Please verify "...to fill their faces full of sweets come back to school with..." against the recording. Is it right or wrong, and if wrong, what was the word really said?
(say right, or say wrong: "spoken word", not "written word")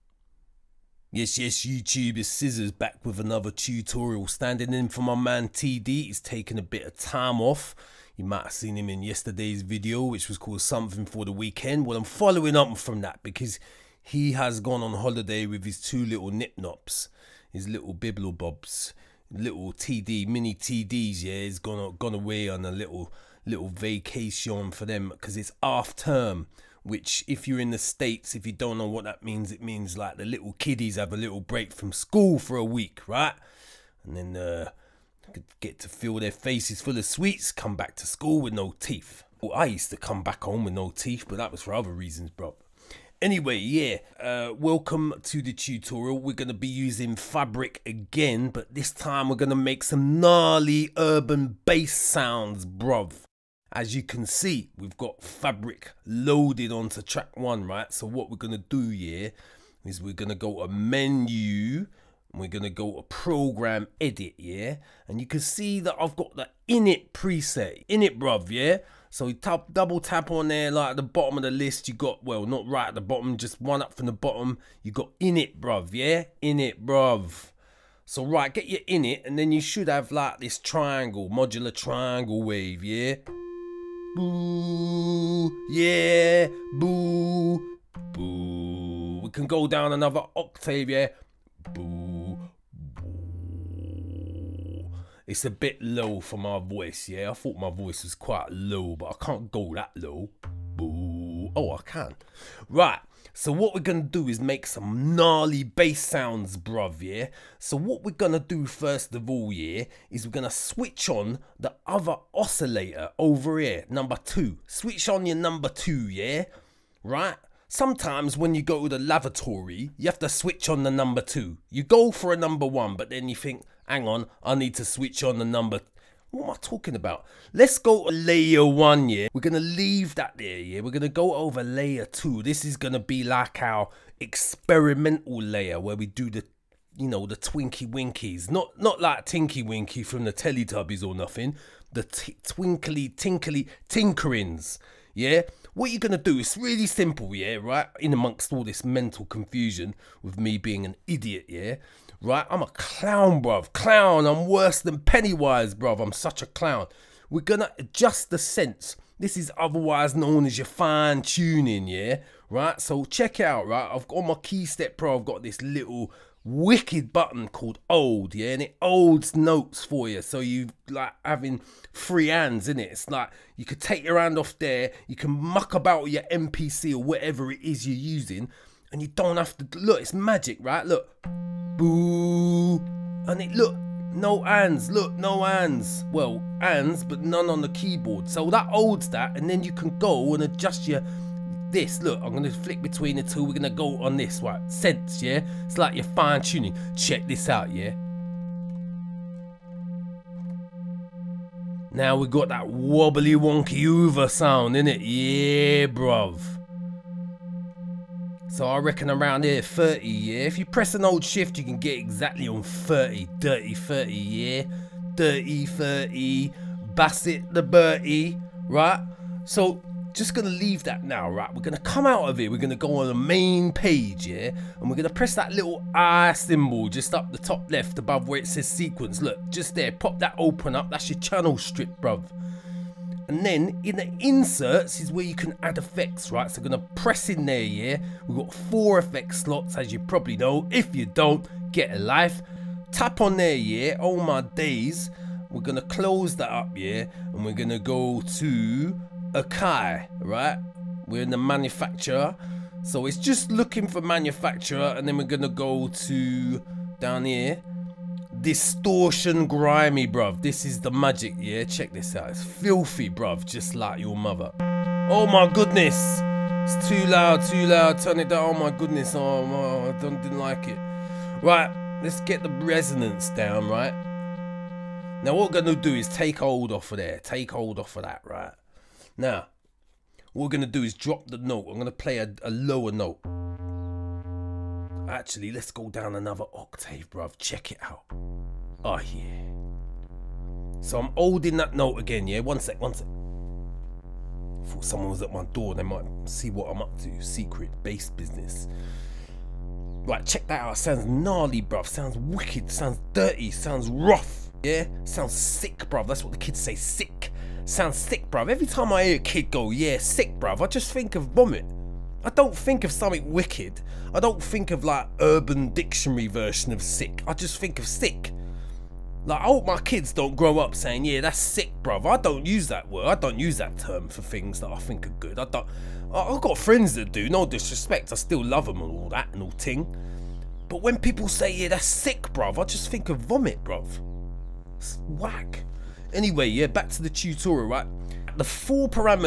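right.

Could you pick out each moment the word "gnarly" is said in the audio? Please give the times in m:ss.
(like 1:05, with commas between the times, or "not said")
0:50, 1:45, 5:01.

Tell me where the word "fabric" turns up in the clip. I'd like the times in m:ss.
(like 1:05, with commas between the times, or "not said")
0:47, 0:55.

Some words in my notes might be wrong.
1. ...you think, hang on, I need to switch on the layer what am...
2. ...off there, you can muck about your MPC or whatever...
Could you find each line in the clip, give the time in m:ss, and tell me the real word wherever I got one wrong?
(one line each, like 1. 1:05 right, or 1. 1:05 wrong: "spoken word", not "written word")
1. 2:03 wrong: "number", not "layer"
2. 2:54 right.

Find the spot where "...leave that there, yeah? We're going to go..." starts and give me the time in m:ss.
2:09.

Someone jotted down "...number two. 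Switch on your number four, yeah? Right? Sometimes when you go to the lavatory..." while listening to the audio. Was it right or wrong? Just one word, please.
wrong.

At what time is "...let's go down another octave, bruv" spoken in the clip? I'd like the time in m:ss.
4:45.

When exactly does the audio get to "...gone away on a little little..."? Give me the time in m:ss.
0:21.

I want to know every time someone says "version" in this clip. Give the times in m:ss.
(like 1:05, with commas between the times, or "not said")
5:16.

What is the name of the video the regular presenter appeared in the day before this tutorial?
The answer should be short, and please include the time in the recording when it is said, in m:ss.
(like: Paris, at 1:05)
Something for the Weekend, at 0:10.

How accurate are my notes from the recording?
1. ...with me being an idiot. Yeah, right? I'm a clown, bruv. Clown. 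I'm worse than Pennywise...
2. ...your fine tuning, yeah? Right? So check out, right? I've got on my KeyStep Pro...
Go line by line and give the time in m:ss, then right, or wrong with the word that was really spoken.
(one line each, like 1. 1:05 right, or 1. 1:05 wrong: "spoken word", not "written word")
1. 2:30 right
2. 2:40 right.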